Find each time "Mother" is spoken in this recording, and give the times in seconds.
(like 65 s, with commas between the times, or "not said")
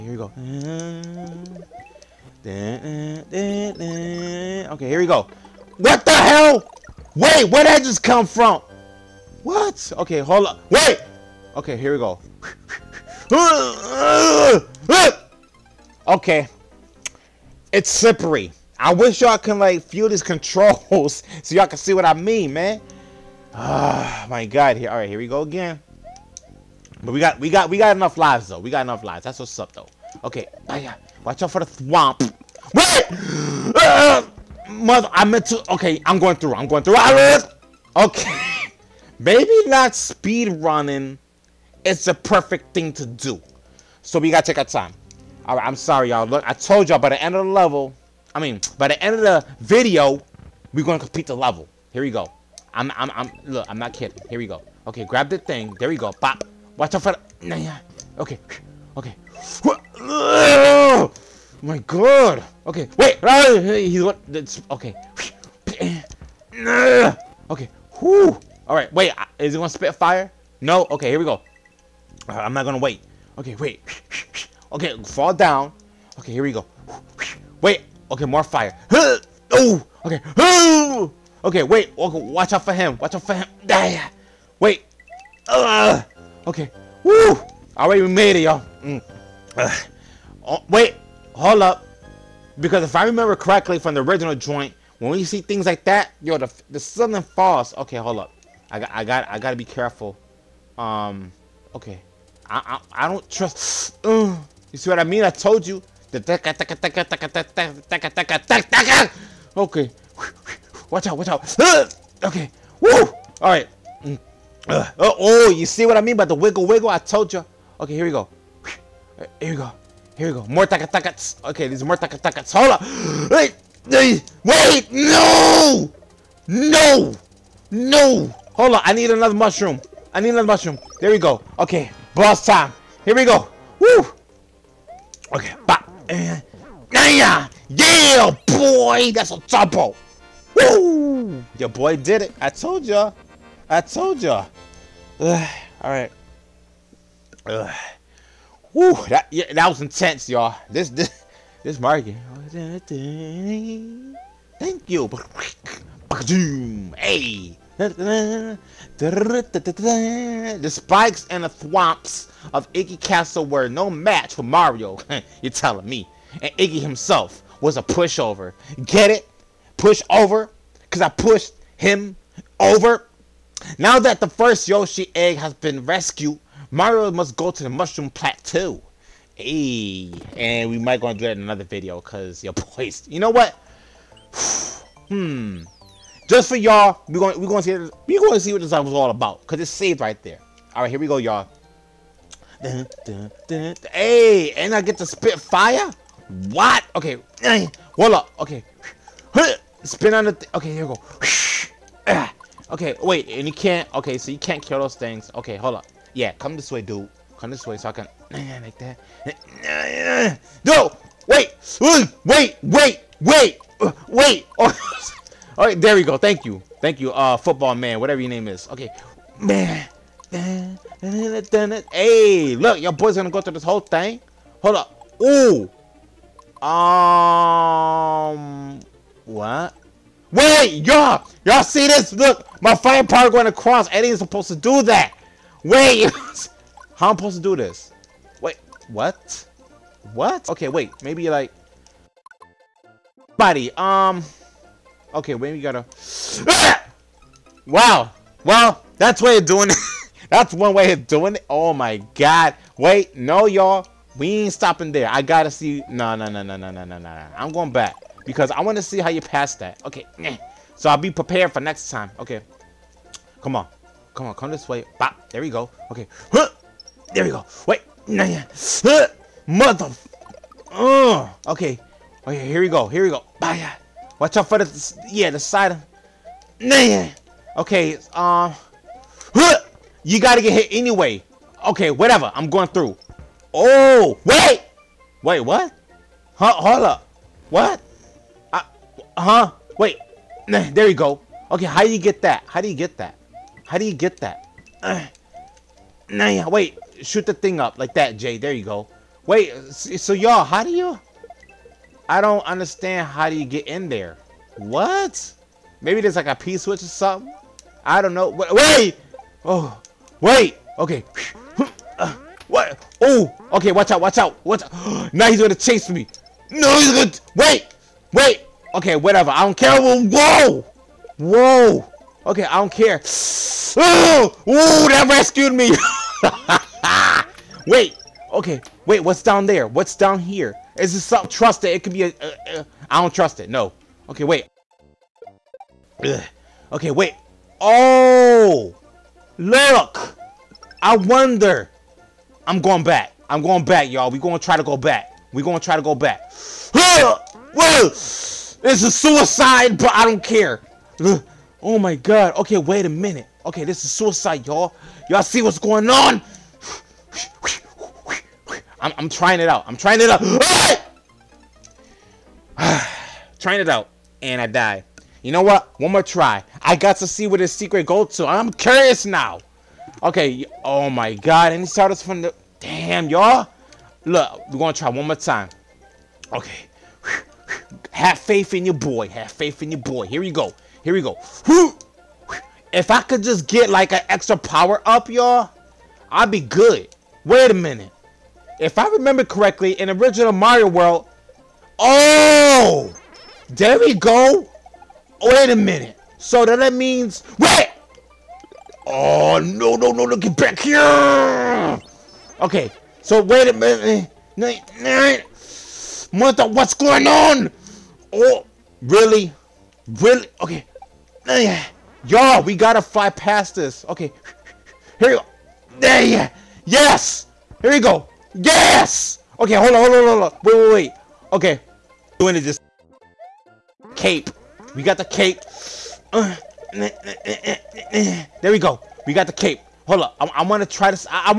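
34 s, 269 s, 406 s.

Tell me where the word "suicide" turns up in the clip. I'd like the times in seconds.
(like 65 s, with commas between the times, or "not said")
348 s, 353 s.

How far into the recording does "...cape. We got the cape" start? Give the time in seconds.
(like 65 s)
423 s.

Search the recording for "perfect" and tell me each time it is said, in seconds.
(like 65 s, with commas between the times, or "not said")
42 s.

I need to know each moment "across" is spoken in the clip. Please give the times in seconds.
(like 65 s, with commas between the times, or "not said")
233 s.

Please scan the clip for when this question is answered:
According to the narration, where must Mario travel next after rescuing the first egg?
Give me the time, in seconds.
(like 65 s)
177 s.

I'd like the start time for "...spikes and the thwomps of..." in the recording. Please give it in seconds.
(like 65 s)
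160 s.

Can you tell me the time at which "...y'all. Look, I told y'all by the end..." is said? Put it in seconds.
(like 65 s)
46 s.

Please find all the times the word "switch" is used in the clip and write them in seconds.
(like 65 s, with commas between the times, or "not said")
306 s.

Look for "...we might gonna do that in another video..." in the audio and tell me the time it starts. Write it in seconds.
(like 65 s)
180 s.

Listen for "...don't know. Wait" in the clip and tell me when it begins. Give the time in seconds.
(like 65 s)
308 s.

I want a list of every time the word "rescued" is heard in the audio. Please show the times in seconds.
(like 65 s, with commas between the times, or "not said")
175 s, 325 s.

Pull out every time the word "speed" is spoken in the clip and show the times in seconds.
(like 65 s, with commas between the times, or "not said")
39 s.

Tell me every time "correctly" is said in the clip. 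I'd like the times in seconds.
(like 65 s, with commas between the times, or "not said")
93 s, 389 s.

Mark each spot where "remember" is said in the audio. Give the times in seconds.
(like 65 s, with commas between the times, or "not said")
93 s, 388 s.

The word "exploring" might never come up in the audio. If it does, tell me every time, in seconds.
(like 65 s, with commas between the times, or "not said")
not said.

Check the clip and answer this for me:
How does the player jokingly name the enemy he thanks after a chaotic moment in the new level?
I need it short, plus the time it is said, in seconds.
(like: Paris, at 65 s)
football man, at 217 s.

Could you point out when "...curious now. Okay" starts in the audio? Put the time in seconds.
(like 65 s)
368 s.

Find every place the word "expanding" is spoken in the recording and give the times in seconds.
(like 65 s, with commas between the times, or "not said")
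not said.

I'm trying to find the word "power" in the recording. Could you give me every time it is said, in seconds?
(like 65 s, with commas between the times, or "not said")
233 s, 384 s.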